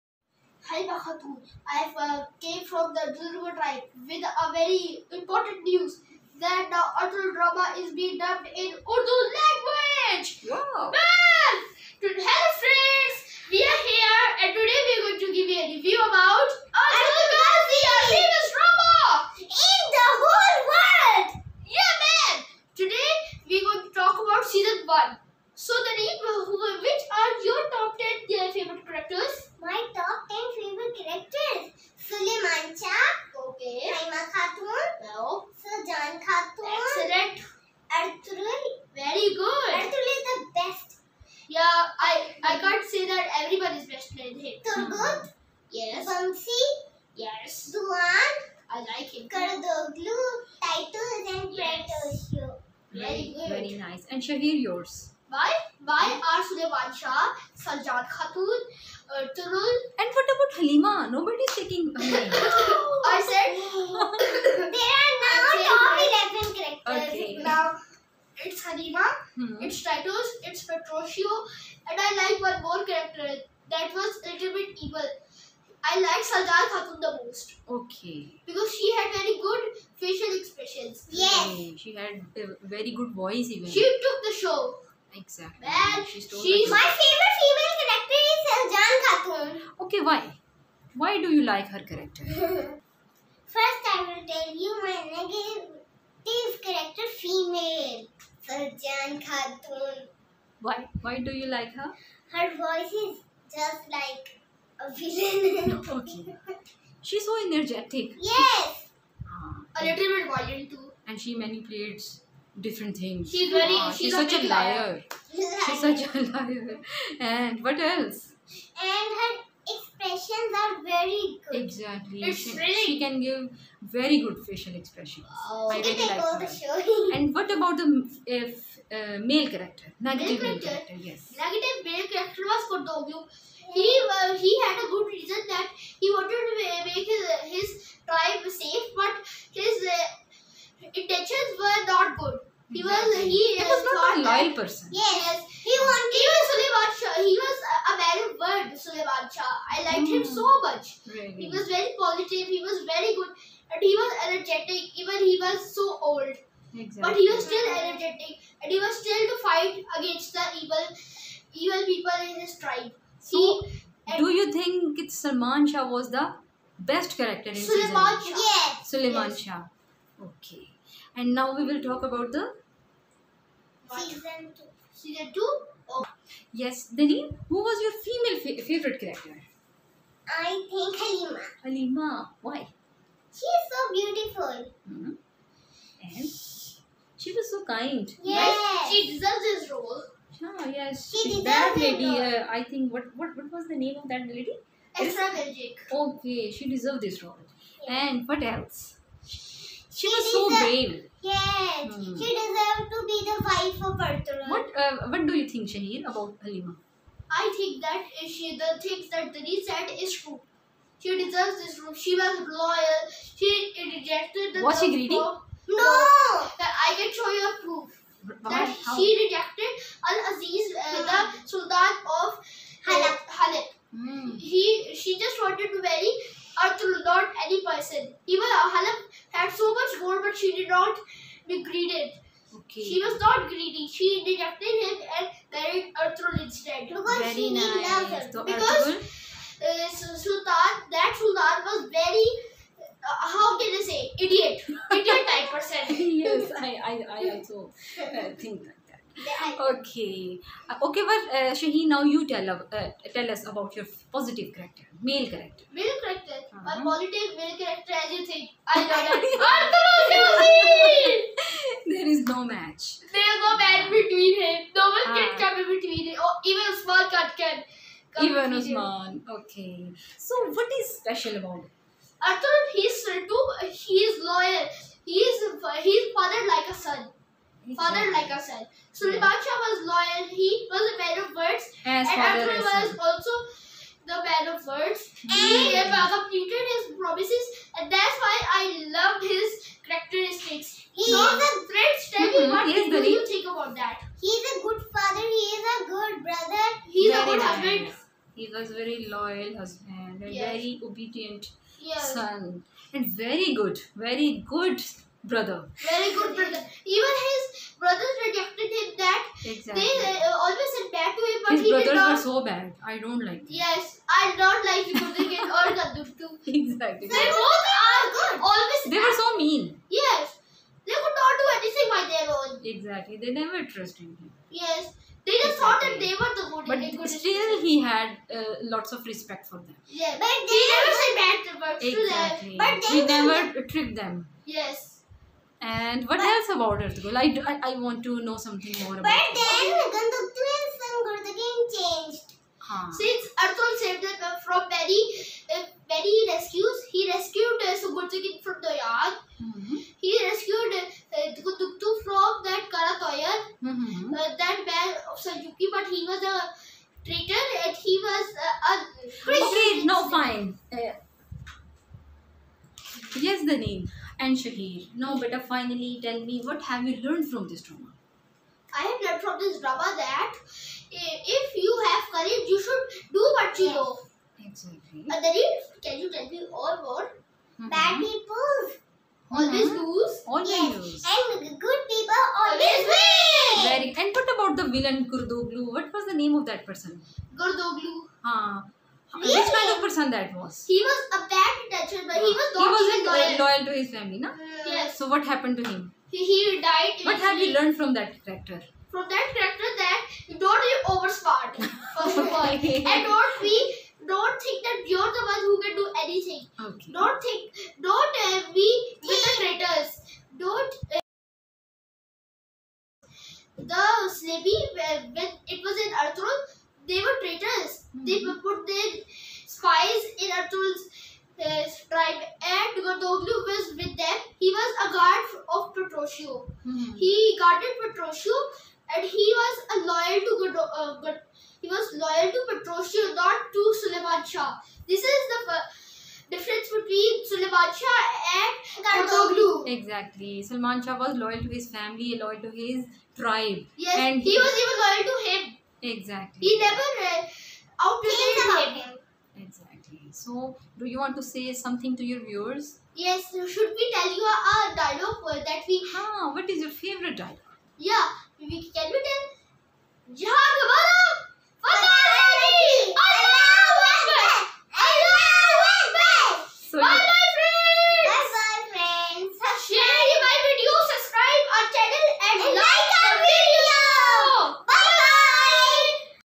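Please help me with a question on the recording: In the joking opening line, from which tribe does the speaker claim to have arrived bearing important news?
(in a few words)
Durga tribe.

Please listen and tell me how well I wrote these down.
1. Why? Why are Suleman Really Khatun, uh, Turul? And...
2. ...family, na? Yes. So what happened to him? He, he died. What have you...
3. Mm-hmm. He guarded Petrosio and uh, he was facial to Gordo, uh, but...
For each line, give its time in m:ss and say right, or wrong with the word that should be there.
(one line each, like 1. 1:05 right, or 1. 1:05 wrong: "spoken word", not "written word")
1. 0:55 wrong: "Sajjad", not "Really"
2. 6:33 right
3. 7:06 wrong: "loyal", not "facial".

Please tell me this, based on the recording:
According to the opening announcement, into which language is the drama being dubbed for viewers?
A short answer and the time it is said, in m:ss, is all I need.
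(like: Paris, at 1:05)
Urdu, at 0:08.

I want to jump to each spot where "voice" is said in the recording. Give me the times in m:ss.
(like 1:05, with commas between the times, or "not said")
1:23, 1:42.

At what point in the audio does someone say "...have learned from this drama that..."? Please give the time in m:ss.
6:08.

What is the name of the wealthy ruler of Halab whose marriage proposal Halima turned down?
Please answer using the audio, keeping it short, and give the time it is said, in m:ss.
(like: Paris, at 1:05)
Al Aziz, at 3:40.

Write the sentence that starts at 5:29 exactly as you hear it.
Yeah, but they he never said bad words exactly.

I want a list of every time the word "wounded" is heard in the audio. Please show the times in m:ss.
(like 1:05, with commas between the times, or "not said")
not said.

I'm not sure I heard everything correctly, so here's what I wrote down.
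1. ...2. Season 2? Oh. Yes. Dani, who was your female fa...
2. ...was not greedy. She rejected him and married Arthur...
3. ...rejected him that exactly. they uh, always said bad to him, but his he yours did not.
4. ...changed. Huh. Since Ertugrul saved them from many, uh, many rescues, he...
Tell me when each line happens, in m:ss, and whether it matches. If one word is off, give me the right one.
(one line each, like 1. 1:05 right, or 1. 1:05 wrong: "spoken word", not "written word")
1. 2:54 right
2. 3:53 right
3. 5:08 wrong: "brothers", not "yours"
4. 5:41 right.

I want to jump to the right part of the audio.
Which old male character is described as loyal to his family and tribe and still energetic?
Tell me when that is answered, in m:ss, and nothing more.
2:26.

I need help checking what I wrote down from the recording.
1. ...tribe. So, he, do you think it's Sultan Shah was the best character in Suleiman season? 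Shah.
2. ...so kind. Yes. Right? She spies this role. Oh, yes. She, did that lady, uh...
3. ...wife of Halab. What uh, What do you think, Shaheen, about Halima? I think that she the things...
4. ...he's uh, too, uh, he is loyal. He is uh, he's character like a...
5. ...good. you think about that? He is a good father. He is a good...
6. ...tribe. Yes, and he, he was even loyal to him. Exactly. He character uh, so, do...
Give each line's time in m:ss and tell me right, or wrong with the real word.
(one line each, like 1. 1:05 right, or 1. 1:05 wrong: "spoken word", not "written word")
1. 2:42 wrong: "Salman", not "Sultan"
2. 3:07 wrong: "deserves", not "spies"
3. 3:23 wrong: "Arthur", not "Halab"
4. 4:32 wrong: "father", not "character"
5. 4:52 right
6. 7:23 wrong: "never", not "character".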